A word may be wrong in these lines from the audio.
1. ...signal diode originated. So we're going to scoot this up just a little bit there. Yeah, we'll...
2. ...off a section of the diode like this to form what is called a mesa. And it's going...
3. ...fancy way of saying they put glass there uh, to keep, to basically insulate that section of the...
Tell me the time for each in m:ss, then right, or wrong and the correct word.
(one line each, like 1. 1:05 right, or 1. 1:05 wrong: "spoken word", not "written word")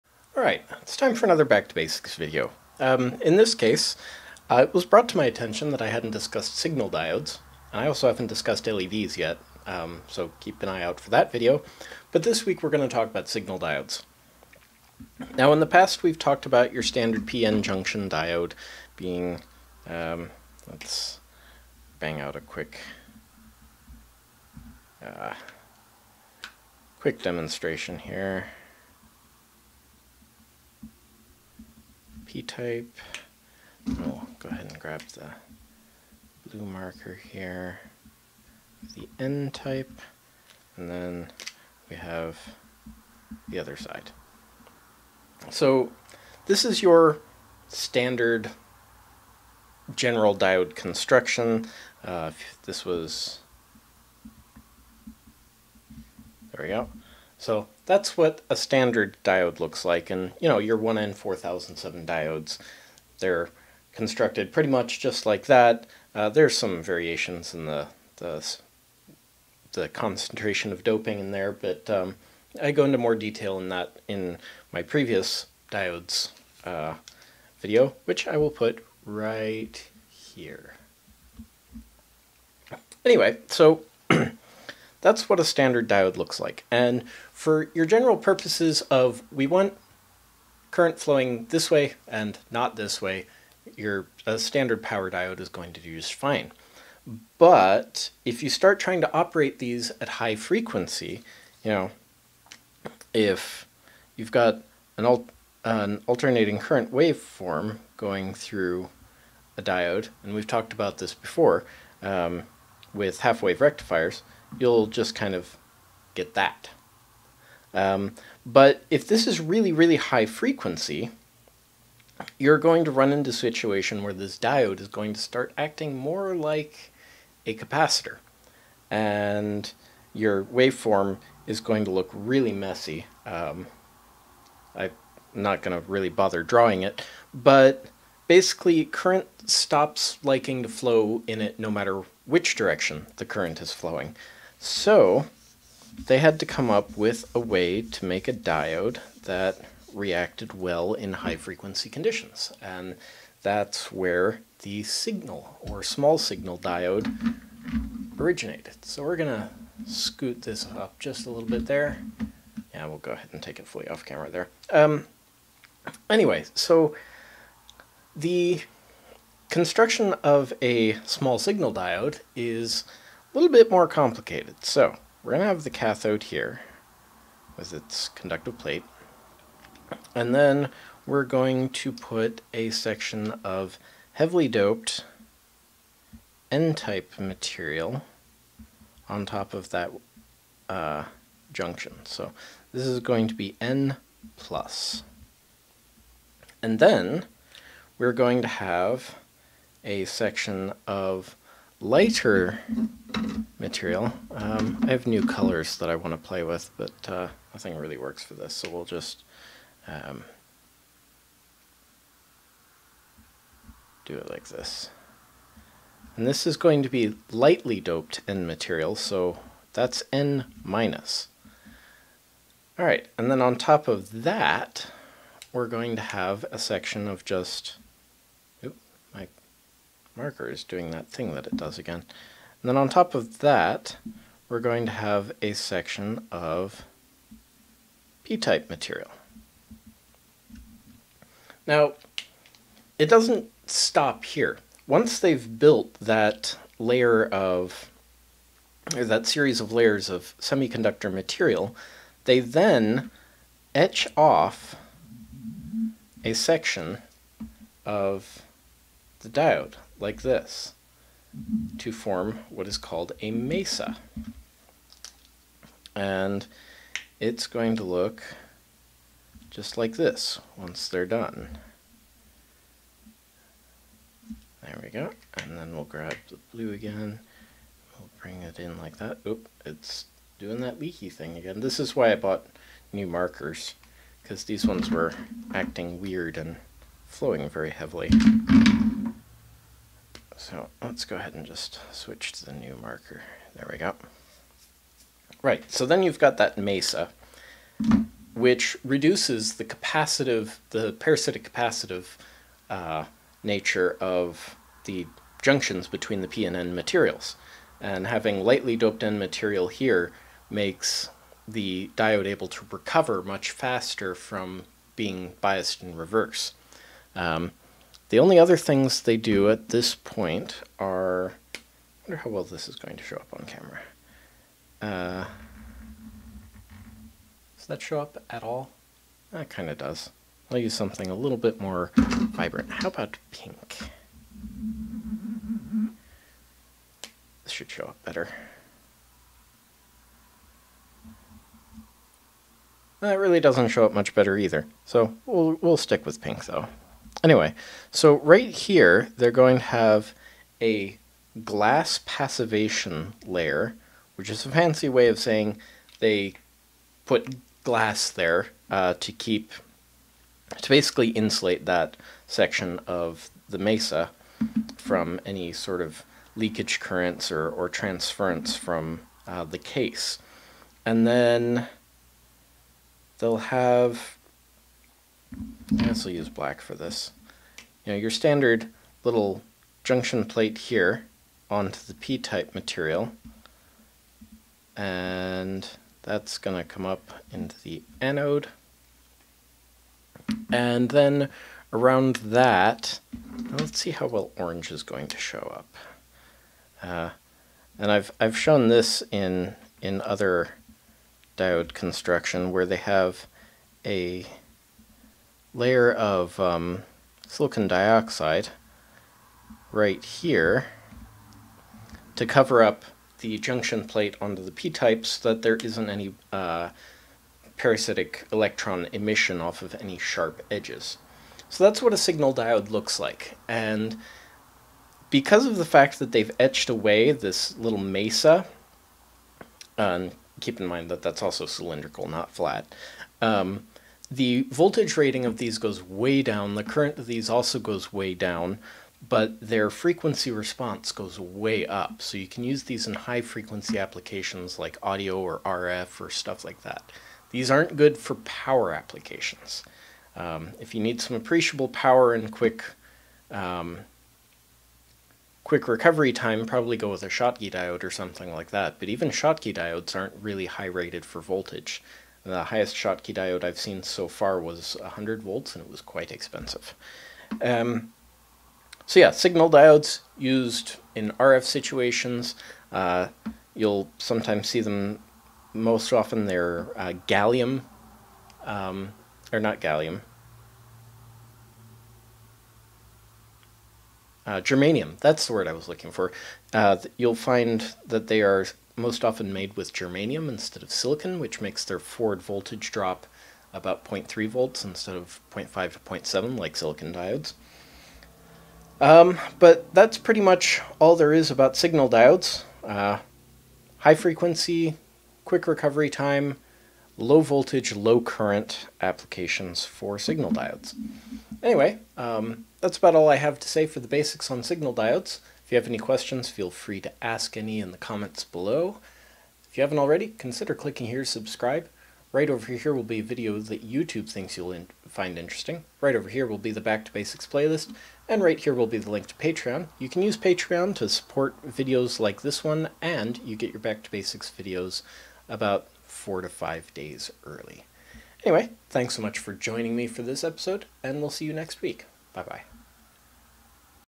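1. 2:36 right
2. 4:14 right
3. 5:54 right.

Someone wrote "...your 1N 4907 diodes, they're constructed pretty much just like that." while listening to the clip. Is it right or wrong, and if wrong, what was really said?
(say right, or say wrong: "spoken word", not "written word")
wrong: "4007", not "4907".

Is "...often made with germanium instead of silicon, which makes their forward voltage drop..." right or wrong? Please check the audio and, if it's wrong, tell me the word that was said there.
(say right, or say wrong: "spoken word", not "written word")
right.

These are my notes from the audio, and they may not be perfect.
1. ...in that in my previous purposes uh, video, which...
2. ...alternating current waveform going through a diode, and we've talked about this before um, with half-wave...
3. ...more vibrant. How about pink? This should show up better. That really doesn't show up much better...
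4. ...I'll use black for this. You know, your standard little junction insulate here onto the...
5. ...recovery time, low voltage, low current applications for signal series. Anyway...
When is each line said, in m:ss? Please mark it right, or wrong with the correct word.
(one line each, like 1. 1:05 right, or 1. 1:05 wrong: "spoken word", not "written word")
1. 1:13 wrong: "diodes", not "purposes"
2. 1:46 right
3. 5:31 right
4. 6:16 wrong: "plate", not "insulate"
5. 8:25 wrong: "diodes", not "series".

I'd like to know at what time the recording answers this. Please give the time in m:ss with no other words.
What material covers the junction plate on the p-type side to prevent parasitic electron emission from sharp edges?
6:47.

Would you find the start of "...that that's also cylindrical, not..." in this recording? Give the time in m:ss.
7:10.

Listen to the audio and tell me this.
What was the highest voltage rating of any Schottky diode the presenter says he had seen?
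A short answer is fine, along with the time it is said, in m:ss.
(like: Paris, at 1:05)
100 volts, at 7:44.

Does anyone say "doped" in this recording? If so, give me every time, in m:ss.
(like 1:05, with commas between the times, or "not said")
3:04, 3:37, 5:08.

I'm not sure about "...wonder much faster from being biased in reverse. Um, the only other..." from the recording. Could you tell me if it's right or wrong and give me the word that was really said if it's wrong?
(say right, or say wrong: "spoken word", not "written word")
wrong: "recover", not "wonder".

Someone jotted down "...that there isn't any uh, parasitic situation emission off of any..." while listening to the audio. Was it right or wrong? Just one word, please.
wrong.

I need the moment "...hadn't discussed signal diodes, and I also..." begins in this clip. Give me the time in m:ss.
0:05.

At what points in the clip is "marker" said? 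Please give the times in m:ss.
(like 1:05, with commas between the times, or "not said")
0:36, 3:50, 4:43, 4:52.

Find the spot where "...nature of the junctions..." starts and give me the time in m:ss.
5:03.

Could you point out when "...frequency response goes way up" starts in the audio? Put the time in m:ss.
7:19.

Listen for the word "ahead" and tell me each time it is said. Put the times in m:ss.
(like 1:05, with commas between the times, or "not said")
0:34, 2:43, 4:51.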